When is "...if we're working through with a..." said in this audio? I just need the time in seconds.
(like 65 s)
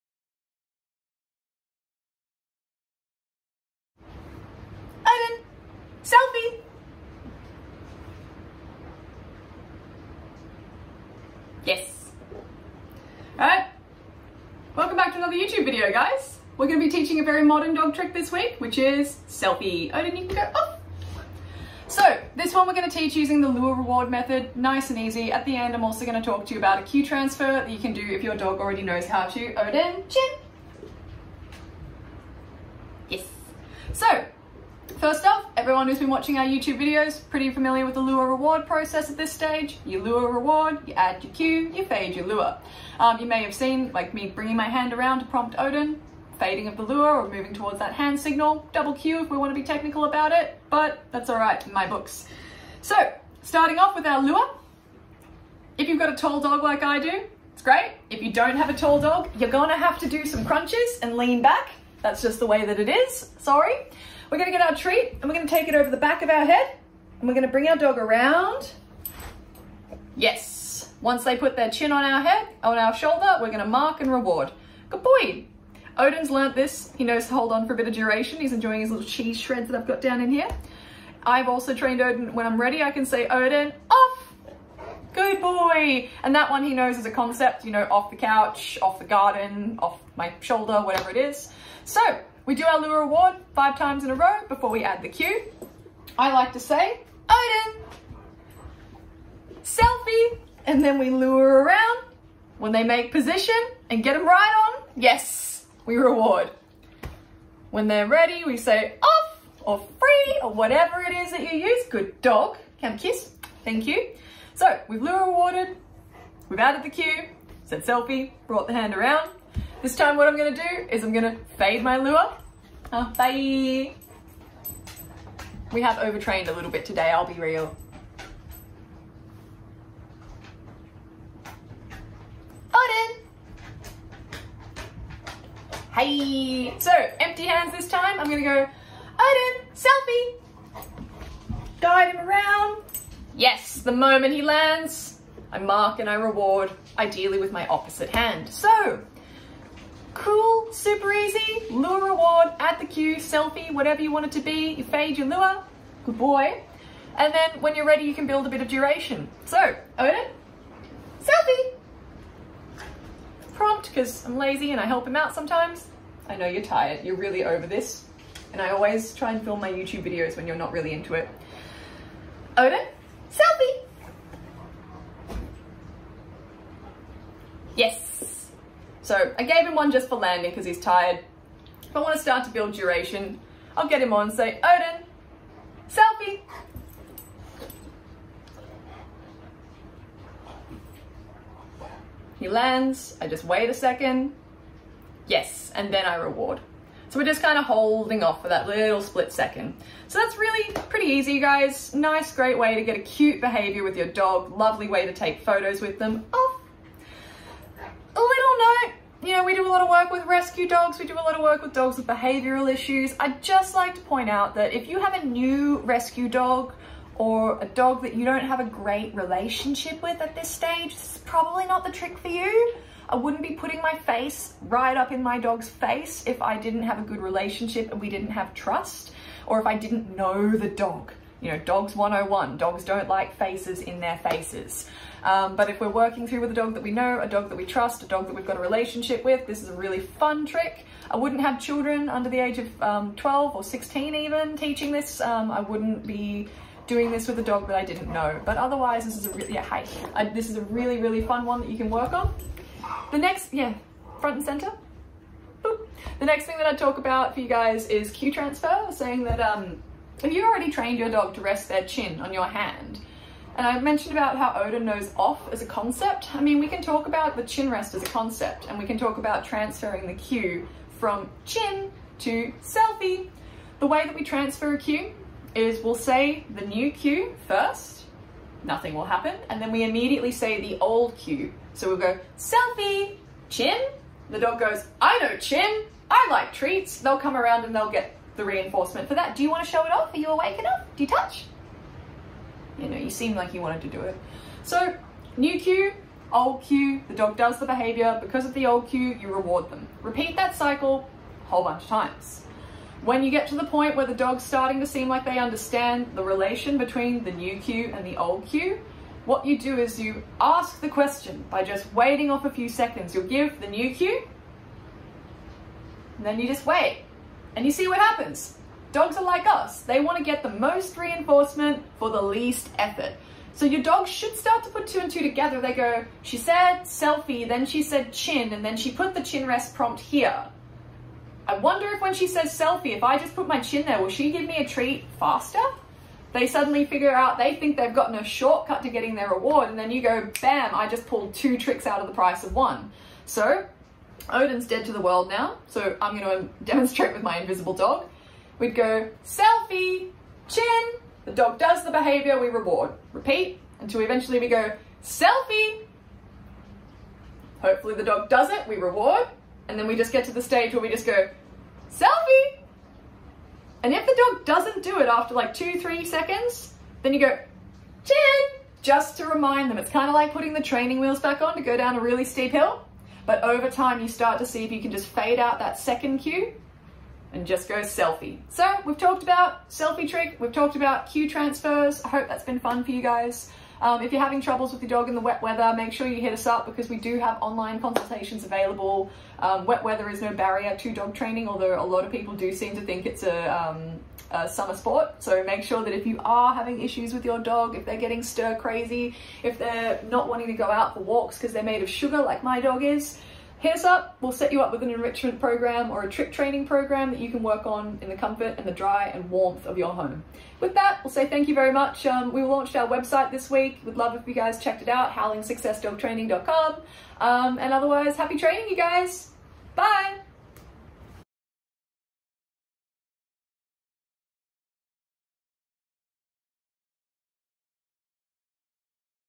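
235 s.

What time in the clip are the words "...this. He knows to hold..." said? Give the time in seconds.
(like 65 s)
76 s.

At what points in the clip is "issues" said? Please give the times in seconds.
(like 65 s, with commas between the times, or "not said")
212 s, 396 s.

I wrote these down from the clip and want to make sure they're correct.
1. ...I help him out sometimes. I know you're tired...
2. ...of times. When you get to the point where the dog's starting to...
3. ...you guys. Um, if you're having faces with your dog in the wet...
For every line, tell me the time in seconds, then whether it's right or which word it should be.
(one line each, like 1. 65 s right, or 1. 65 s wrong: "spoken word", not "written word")
1. 164 s right
2. 301 s right
3. 382 s wrong: "troubles", not "faces".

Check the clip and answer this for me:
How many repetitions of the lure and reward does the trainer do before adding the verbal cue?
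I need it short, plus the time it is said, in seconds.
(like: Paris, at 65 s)
5, at 93 s.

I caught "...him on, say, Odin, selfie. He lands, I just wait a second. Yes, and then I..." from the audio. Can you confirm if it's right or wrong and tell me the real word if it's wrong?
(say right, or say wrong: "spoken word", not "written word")
right.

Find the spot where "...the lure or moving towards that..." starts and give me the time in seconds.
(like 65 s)
46 s.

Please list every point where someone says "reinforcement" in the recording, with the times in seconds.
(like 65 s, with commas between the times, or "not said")
288 s, 320 s.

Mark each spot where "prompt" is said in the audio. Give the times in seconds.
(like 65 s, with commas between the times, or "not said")
45 s, 163 s, 329 s.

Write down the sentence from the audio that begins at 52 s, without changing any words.
So, starting off with our lure, if you've got a tall dog like I do, it's great.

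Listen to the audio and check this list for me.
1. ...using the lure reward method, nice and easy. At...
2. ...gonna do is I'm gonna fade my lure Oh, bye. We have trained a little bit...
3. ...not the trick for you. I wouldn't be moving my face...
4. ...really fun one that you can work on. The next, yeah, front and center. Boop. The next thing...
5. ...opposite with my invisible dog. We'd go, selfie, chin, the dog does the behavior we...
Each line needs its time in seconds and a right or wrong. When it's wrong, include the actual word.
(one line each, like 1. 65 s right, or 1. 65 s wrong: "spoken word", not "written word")
1. 23 s right
2. 120 s wrong: "overtrained", not "trained"
3. 221 s wrong: "putting", not "moving"
4. 251 s right
5. 346 s wrong: "demonstrate", not "opposite".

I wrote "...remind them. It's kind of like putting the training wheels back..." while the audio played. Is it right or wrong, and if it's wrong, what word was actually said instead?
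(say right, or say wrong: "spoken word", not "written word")
right.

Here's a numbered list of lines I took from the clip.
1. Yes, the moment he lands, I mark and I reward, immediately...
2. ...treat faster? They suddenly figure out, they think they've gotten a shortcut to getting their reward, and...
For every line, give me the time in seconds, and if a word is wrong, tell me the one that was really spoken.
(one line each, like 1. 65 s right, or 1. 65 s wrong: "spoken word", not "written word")
1. 143 s wrong: "ideally", not "immediately"
2. 334 s right.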